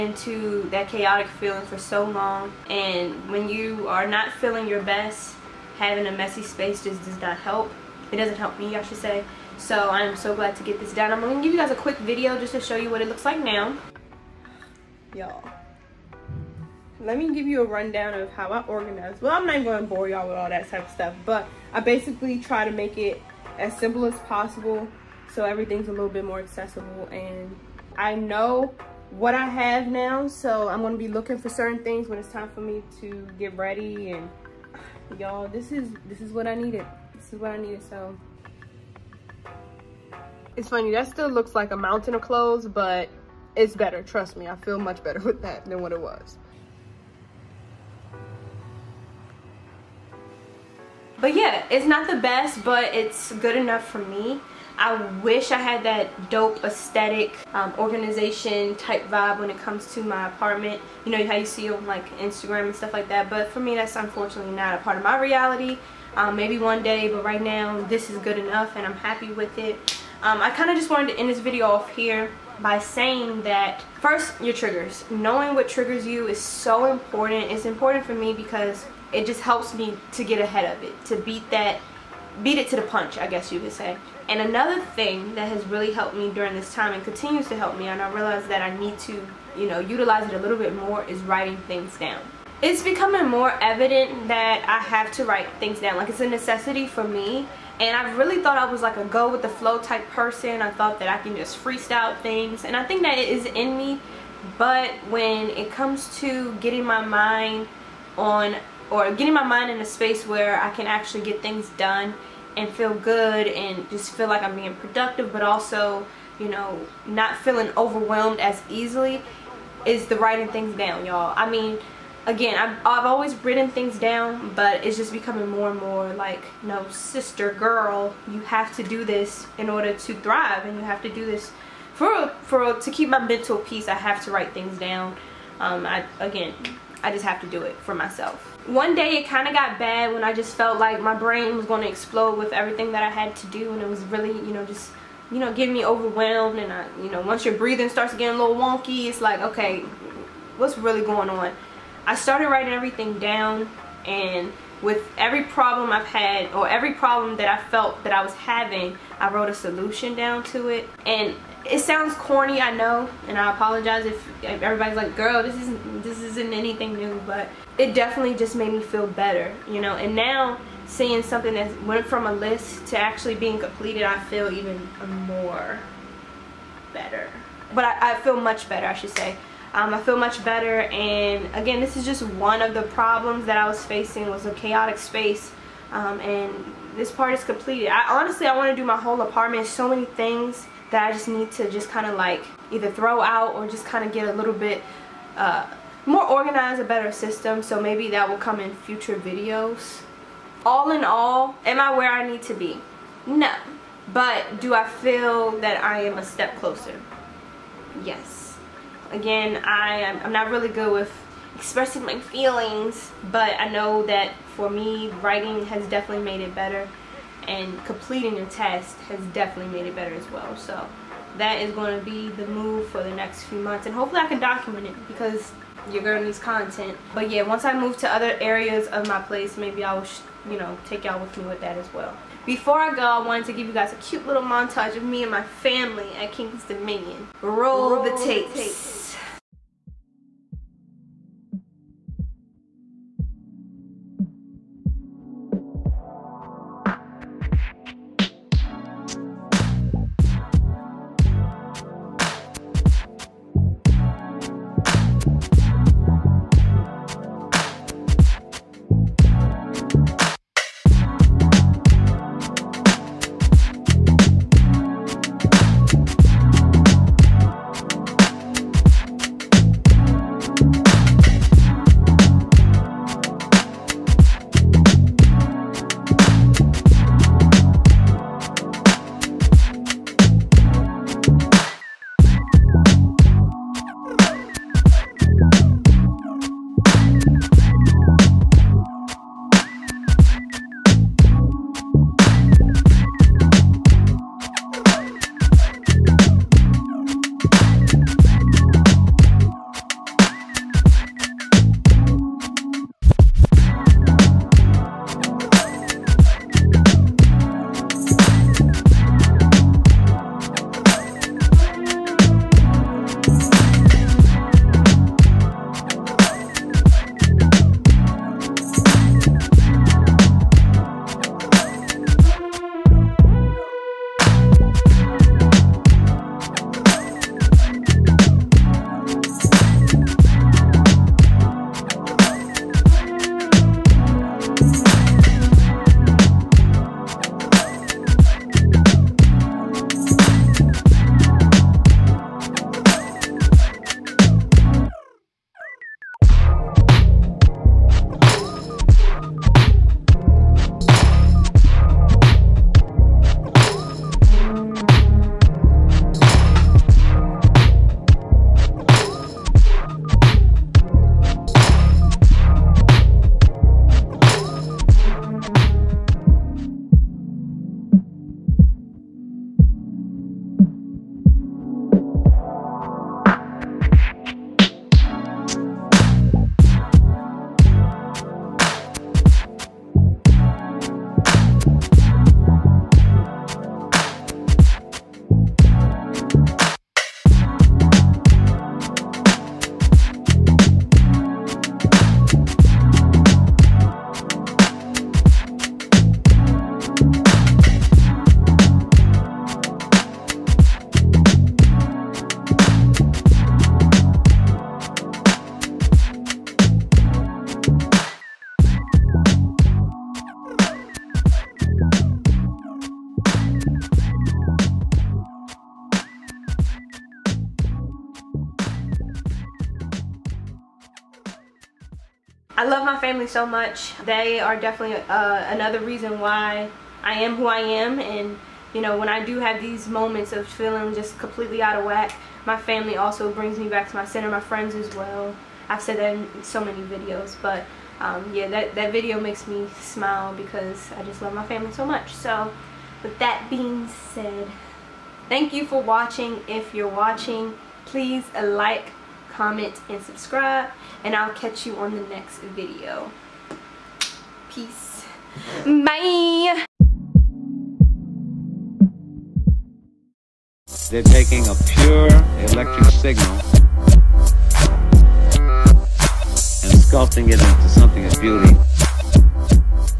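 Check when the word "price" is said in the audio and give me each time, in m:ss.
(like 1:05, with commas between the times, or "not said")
not said.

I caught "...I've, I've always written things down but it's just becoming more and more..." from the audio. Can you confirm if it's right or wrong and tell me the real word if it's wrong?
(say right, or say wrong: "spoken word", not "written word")
right.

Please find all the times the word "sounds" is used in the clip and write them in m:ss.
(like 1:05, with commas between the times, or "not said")
2:41.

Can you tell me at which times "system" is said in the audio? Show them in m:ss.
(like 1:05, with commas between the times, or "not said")
3:17.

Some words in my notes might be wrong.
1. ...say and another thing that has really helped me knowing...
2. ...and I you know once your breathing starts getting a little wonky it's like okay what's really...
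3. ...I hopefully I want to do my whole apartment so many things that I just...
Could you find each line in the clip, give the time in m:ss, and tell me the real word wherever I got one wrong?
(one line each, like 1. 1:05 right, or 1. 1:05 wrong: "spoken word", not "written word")
1. 1:23 wrong: "during", not "knowing"
2. 2:26 right
3. 3:07 wrong: "honestly", not "hopefully".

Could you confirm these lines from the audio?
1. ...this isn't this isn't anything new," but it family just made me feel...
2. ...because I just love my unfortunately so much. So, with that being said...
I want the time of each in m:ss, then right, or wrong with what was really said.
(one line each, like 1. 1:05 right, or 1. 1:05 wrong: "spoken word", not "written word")
1. 2:45 wrong: "definitely", not "family"
2. 7:20 wrong: "family", not "unfortunately".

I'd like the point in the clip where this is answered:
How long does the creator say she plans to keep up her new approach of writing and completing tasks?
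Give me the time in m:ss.
3:43.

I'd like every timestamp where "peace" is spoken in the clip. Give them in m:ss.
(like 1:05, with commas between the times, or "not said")
2:13, 7:34.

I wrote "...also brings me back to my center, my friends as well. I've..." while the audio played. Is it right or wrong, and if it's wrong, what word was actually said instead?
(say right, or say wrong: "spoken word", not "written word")
right.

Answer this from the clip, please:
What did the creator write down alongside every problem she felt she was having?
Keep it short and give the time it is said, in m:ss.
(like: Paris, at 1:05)
A solution, at 2:39.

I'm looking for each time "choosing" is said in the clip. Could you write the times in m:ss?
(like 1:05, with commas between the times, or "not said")
not said.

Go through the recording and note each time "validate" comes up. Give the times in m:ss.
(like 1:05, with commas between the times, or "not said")
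not said.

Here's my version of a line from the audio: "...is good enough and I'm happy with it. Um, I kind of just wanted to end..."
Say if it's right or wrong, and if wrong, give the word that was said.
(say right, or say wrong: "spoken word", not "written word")
right.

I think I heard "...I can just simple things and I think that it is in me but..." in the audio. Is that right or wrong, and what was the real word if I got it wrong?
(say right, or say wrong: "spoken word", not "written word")
wrong: "freestyle", not "simple".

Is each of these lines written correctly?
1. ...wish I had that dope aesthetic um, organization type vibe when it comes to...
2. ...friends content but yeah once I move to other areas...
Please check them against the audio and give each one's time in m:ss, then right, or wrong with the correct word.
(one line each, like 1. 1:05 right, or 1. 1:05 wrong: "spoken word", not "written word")
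1. 0:55 right
2. 3:46 wrong: "needs", not "friends".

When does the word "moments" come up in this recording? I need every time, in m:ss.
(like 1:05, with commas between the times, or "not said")
7:09.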